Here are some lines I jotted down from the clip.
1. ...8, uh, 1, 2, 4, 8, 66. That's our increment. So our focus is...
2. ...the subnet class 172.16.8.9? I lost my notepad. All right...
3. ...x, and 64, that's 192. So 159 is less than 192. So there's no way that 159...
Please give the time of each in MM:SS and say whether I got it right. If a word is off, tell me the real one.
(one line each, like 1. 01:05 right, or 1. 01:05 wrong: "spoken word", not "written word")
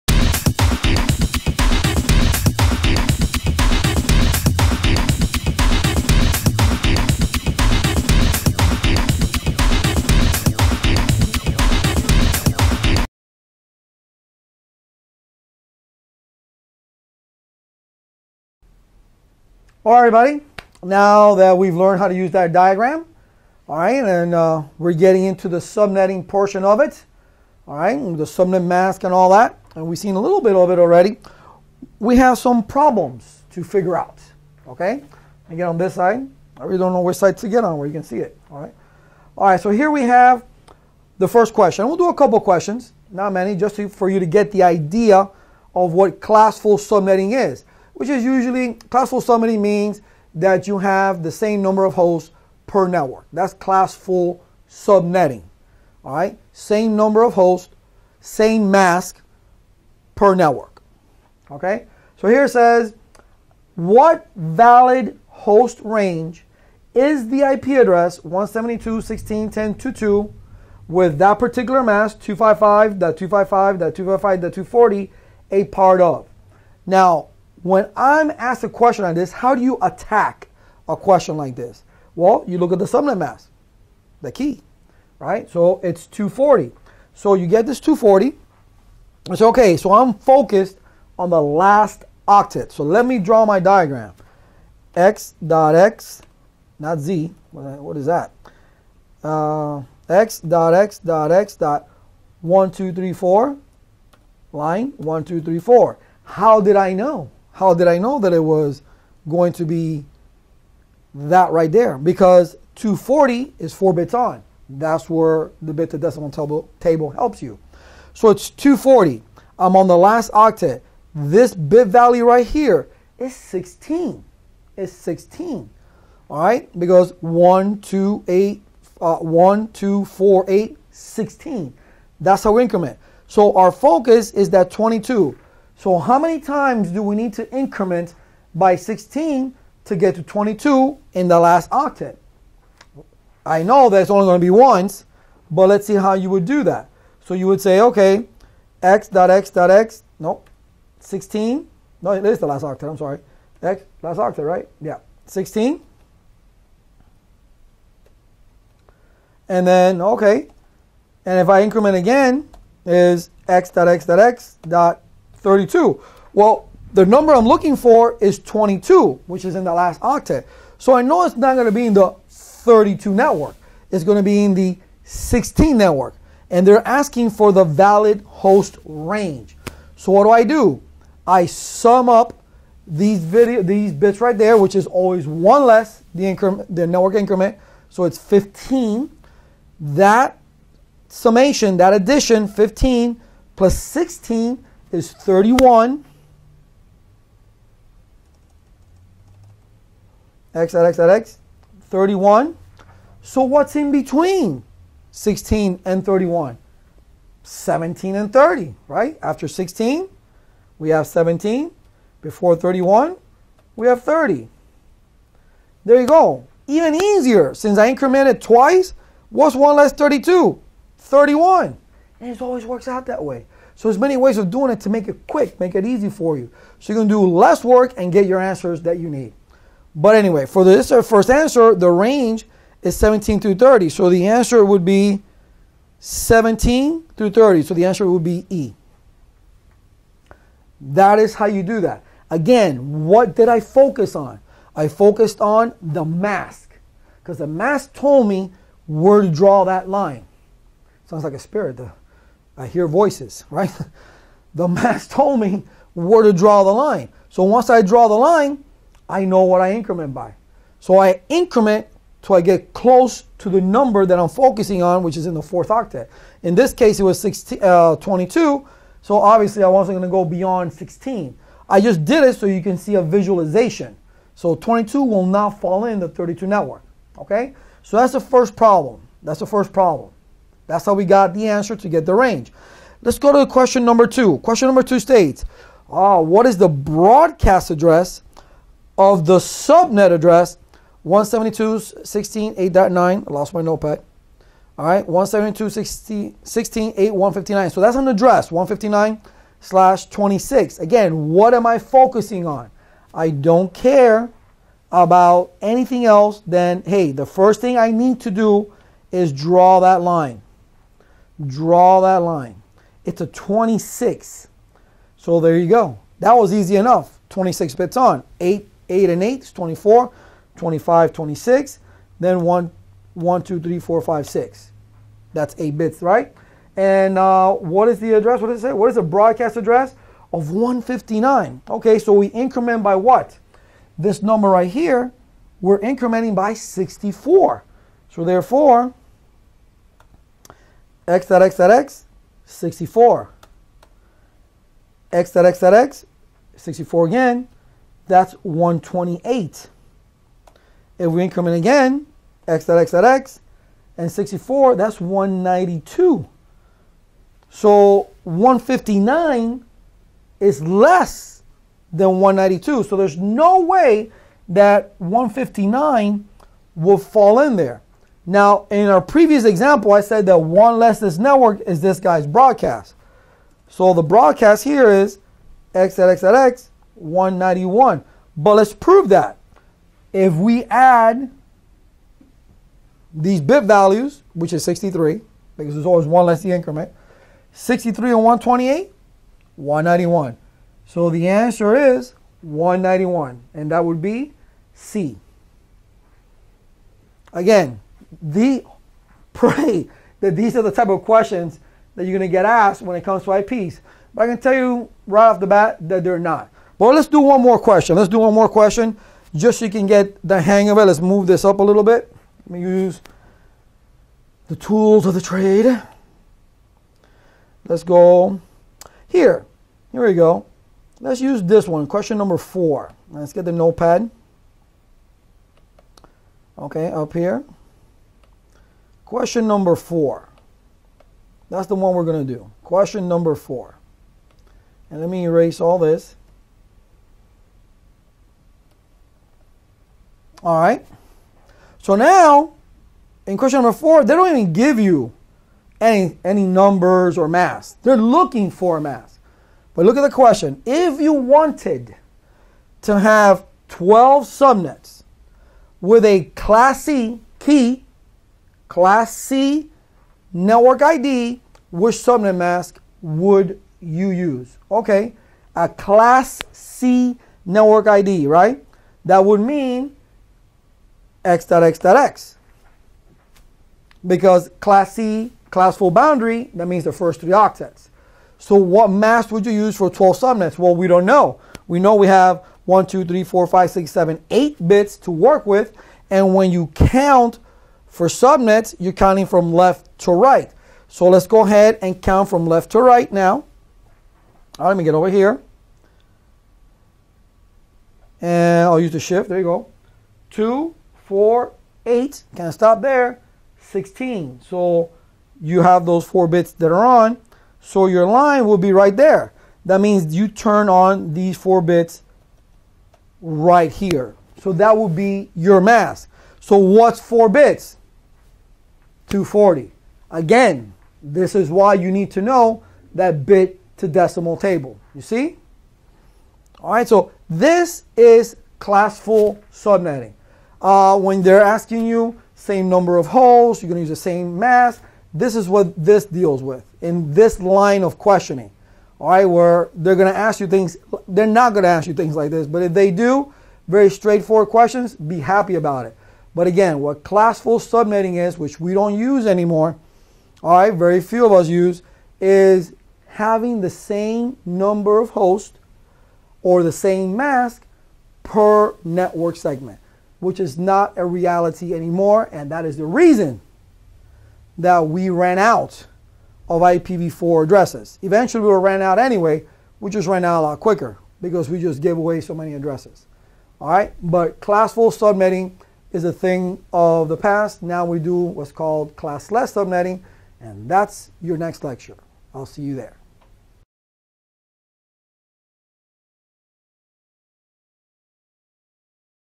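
1. 02:08 wrong: "16", not "66"
2. 04:49 wrong: "address", not "class"
3. 05:53 right.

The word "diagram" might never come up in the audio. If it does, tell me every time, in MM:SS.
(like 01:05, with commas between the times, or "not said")
00:22, 01:33.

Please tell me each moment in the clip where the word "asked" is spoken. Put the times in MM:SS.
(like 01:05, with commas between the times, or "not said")
01:18, 06:42.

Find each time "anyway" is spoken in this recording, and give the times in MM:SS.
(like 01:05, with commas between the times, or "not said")
03:50, 09:28.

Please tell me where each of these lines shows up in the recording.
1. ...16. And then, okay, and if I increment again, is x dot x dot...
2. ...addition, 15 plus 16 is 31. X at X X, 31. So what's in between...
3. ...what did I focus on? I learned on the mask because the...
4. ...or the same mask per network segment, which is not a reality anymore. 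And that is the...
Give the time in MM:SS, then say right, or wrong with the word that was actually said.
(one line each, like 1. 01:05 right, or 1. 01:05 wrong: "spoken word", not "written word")
1. 02:35 right
2. 03:11 right
3. 04:03 wrong: "focused", not "learned"
4. 09:16 right.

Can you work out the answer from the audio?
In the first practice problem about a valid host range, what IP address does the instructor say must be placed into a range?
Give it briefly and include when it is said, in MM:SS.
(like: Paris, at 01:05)
172.16.10.22, at 01:08.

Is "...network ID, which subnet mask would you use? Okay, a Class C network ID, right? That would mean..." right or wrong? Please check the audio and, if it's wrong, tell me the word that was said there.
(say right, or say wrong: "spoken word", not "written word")
right.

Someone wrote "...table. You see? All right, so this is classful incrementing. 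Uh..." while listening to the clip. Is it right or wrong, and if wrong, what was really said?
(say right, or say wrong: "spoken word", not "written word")
wrong: "subnetting", not "incrementing".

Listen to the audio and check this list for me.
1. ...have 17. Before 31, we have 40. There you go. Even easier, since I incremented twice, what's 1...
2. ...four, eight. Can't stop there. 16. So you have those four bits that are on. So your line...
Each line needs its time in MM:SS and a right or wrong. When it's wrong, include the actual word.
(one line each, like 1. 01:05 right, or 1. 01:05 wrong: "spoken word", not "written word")
1. 03:30 wrong: "30", not "40"
2. 08:21 right.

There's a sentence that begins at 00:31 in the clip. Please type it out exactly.
We have some problems to figure out, okay?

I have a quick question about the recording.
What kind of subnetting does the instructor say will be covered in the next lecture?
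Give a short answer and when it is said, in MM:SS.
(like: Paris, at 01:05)
Classless subnetting, at 09:38.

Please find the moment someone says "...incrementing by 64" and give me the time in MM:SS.
05:35.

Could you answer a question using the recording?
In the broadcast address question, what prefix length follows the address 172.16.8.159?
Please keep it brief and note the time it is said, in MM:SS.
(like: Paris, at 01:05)
/26, at 04:59.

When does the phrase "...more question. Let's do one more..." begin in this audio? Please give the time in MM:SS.
06:47.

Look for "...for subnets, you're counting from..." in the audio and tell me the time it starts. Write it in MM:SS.
08:07.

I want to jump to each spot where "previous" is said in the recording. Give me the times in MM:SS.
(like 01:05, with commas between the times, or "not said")
06:09.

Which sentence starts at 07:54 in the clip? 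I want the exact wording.
Because Class C, class full boundary, that means the first three octets.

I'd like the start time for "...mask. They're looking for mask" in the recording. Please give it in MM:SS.
07:27.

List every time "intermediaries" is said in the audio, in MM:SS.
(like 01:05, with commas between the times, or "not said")
not said.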